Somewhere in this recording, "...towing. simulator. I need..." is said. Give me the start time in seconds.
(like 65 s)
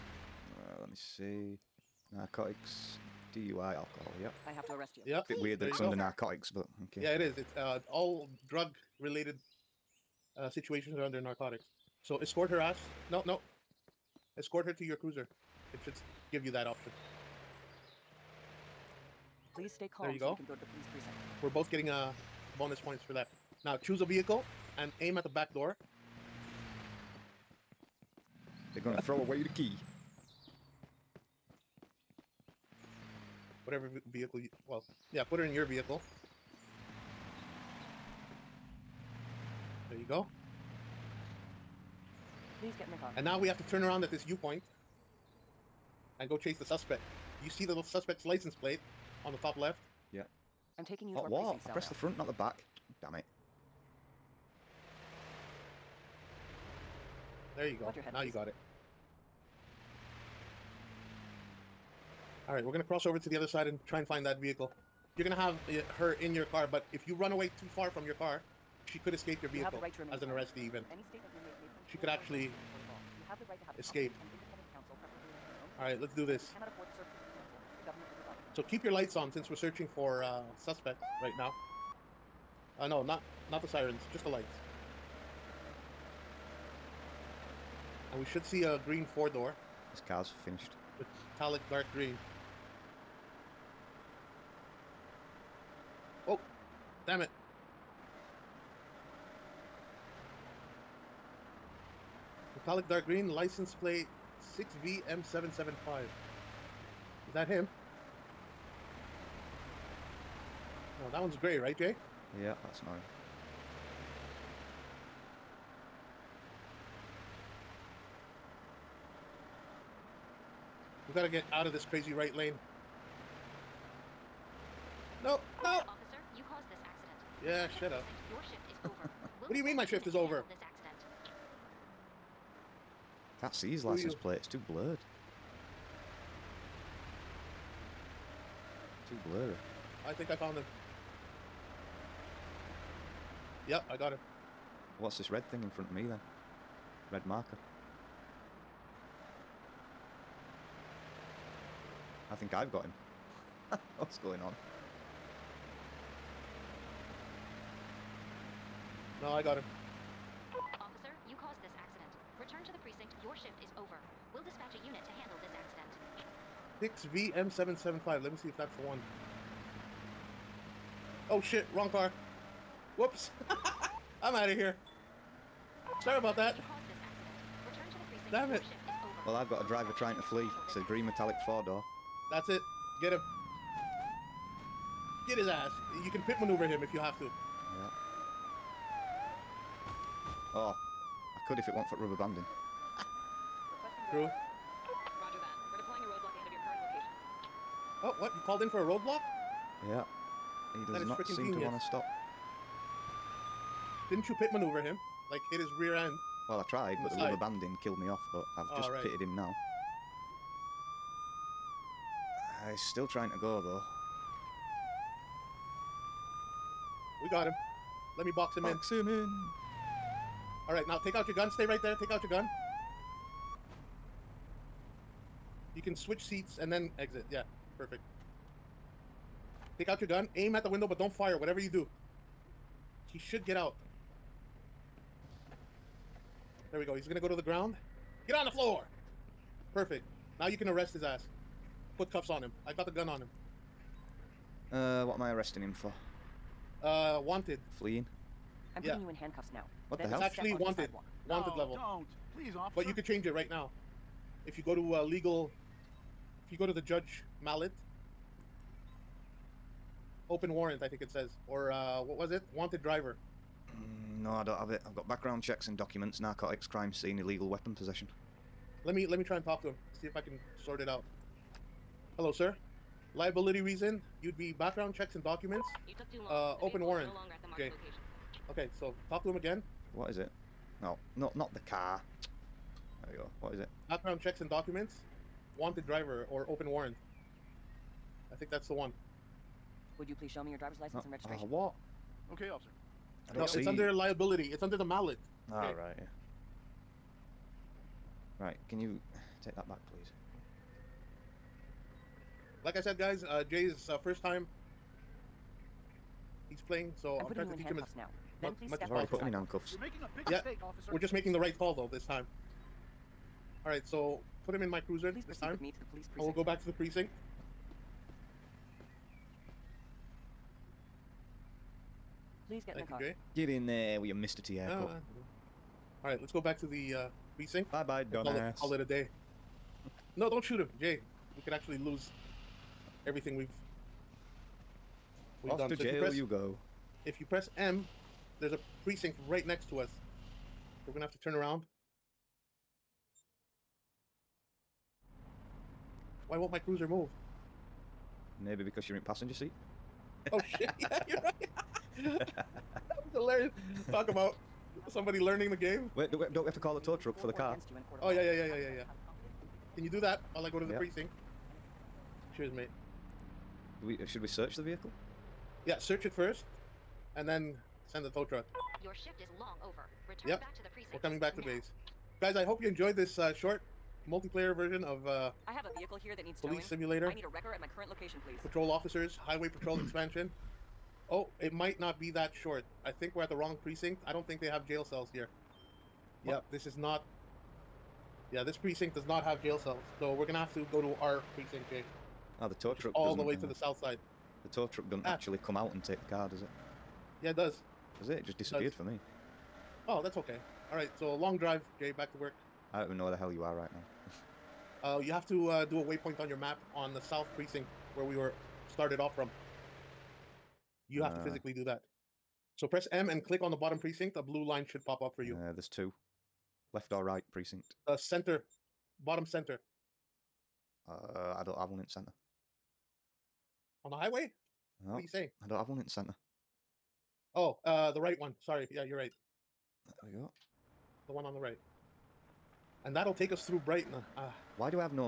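376 s.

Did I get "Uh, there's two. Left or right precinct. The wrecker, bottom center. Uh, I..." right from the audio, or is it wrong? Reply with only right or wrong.
wrong.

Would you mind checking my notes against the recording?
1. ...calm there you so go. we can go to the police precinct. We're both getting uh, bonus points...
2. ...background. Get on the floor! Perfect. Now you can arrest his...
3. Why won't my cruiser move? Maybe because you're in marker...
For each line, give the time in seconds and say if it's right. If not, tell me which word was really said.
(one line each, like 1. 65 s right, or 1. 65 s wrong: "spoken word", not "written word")
1. 19 s right
2. 237 s wrong: "ground", not "background"
3. 346 s wrong: "passenger", not "marker".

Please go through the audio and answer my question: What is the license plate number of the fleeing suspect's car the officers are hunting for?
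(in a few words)
6VM775.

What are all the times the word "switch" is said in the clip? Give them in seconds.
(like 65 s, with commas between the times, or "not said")
225 s.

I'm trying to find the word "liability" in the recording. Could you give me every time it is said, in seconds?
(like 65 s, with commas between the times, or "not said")
273 s, 293 s.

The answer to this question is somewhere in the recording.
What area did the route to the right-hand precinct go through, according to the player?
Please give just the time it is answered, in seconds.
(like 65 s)
433 s.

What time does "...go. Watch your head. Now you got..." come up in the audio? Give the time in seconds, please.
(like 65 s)
57 s.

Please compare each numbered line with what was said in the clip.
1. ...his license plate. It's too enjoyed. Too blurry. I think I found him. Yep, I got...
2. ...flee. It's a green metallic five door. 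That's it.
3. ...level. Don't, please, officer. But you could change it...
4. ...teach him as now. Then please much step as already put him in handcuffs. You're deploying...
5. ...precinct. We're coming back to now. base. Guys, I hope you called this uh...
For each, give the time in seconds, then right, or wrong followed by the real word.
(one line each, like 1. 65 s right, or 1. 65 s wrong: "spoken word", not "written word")
1. 133 s wrong: "blurred", not "enjoyed"
2. 180 s wrong: "four", not "five"
3. 251 s right
4. 307 s wrong: "making", not "deploying"
5. 370 s wrong: "enjoyed", not "called".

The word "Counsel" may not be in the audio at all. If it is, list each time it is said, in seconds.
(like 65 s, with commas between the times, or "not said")
74 s.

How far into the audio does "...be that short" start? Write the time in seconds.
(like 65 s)
381 s.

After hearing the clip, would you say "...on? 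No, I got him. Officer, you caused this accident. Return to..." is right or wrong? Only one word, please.
right.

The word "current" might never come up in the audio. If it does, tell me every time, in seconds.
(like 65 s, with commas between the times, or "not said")
196 s, 377 s.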